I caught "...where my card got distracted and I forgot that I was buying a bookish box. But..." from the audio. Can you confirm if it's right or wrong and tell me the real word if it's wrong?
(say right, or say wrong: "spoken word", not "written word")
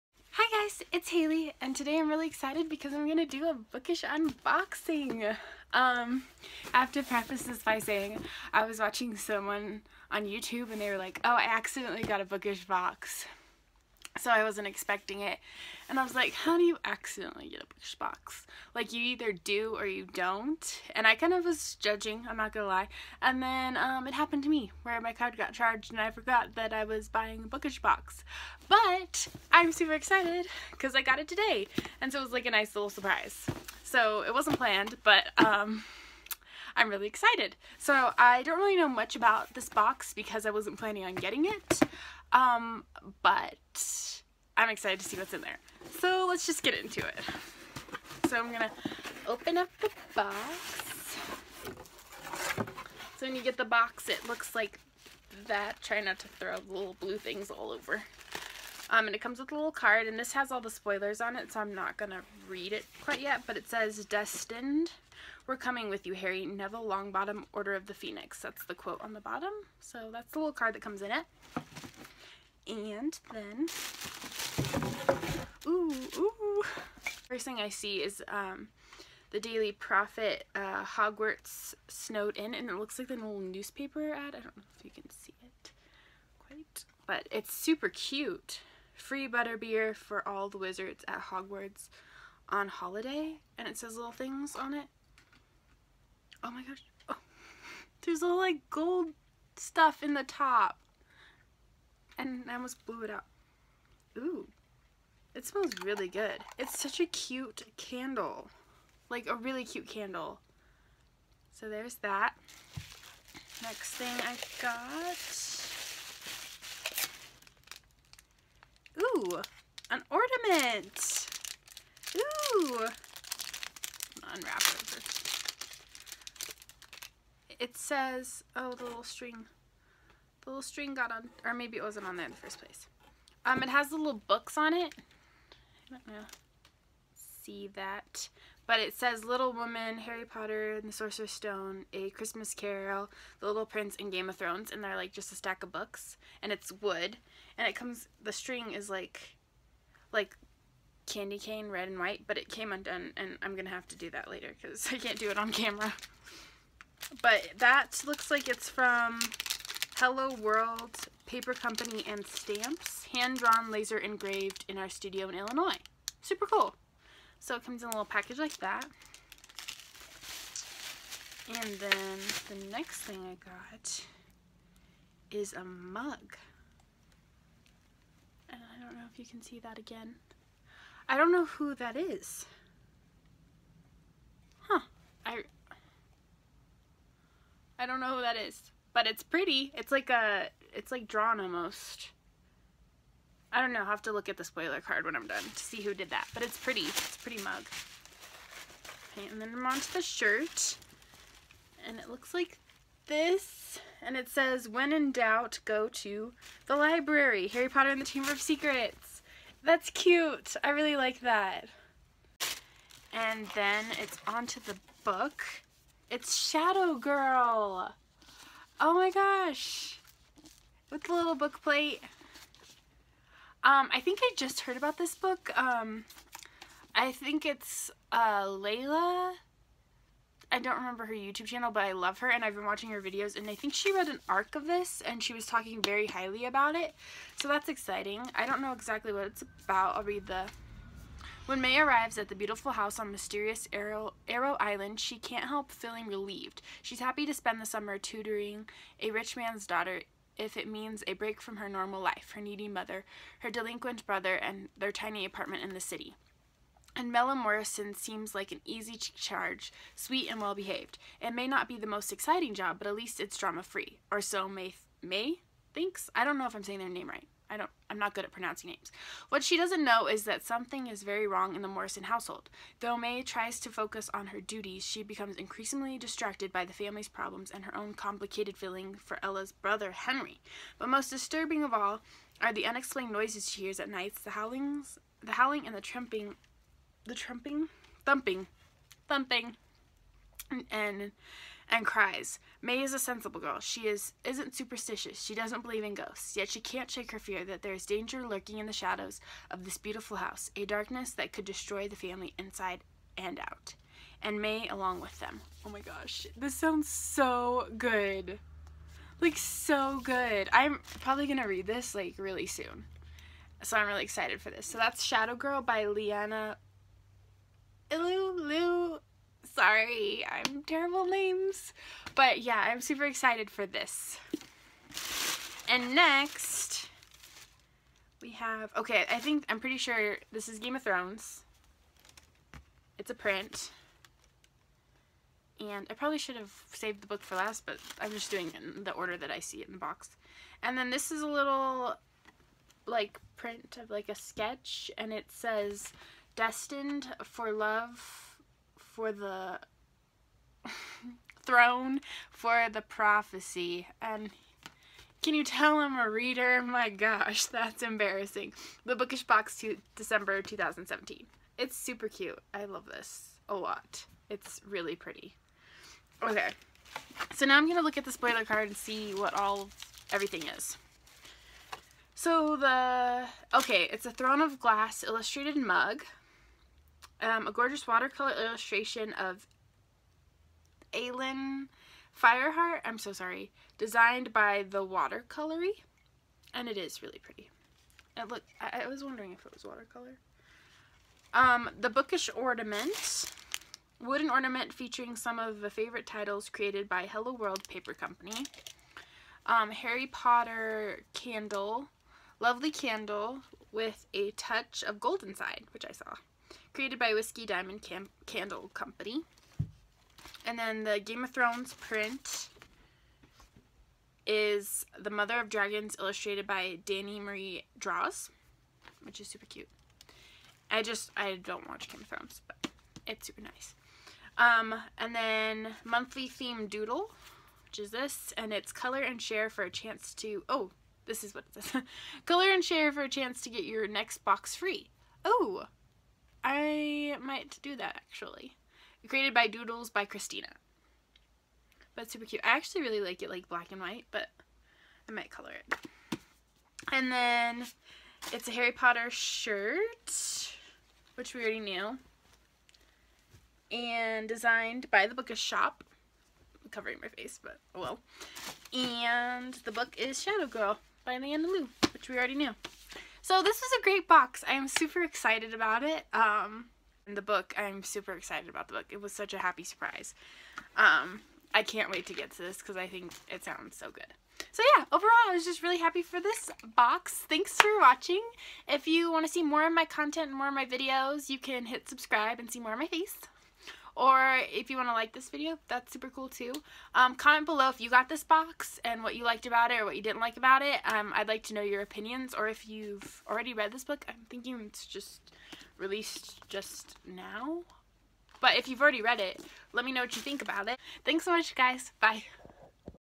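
wrong: "charged", not "distracted".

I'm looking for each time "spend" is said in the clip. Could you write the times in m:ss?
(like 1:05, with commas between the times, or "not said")
4:07.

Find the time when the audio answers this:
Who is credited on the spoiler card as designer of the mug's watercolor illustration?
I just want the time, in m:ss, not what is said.
6:24.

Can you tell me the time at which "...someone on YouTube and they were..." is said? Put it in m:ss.
0:09.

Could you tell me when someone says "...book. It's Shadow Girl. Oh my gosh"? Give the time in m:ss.
3:35.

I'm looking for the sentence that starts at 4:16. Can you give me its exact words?
And Mella Morrison seems like an easy charge, sweet and well behaved.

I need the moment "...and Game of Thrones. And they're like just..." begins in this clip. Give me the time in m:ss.
2:23.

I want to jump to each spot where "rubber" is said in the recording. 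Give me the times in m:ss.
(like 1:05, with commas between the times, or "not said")
not said.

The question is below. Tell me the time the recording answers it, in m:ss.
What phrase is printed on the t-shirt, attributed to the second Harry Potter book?
3:24.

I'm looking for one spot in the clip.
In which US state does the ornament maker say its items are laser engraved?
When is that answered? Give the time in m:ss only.
2:45.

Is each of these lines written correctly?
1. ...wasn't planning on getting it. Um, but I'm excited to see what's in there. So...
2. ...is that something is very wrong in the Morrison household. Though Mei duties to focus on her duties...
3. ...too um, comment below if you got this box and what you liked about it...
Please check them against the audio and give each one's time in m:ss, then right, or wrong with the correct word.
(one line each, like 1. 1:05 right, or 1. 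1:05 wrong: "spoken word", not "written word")
1. 0:40 right
2. 4:30 wrong: "tries", not "duties"
3. 8:06 right.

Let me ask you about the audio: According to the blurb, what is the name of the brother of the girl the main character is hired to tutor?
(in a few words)
Henry.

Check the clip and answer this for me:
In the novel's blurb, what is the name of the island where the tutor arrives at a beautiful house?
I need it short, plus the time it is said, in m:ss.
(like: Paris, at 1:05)
Arrow Island, at 4:04.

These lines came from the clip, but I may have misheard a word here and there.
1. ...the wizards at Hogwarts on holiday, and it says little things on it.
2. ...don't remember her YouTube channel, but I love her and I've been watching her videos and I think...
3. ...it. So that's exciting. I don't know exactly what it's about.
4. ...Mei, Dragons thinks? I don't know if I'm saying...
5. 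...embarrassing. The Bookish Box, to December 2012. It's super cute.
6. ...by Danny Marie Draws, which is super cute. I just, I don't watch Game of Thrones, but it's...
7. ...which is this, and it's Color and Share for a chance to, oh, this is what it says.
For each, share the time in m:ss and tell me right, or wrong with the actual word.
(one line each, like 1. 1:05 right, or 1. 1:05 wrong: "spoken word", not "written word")
1. 1:30 right
2. 3:50 right
3. 3:56 right
4. 4:24 wrong: "Mei", not "Dragons"
5. 5:57 wrong: "2017", not "2012"
6. 6:56 right
7. 7:07 right.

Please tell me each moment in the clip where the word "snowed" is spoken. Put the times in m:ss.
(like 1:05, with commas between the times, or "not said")
1:21.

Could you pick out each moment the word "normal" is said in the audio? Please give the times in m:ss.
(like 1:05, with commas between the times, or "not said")
4:11.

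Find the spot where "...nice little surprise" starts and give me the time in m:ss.
0:32.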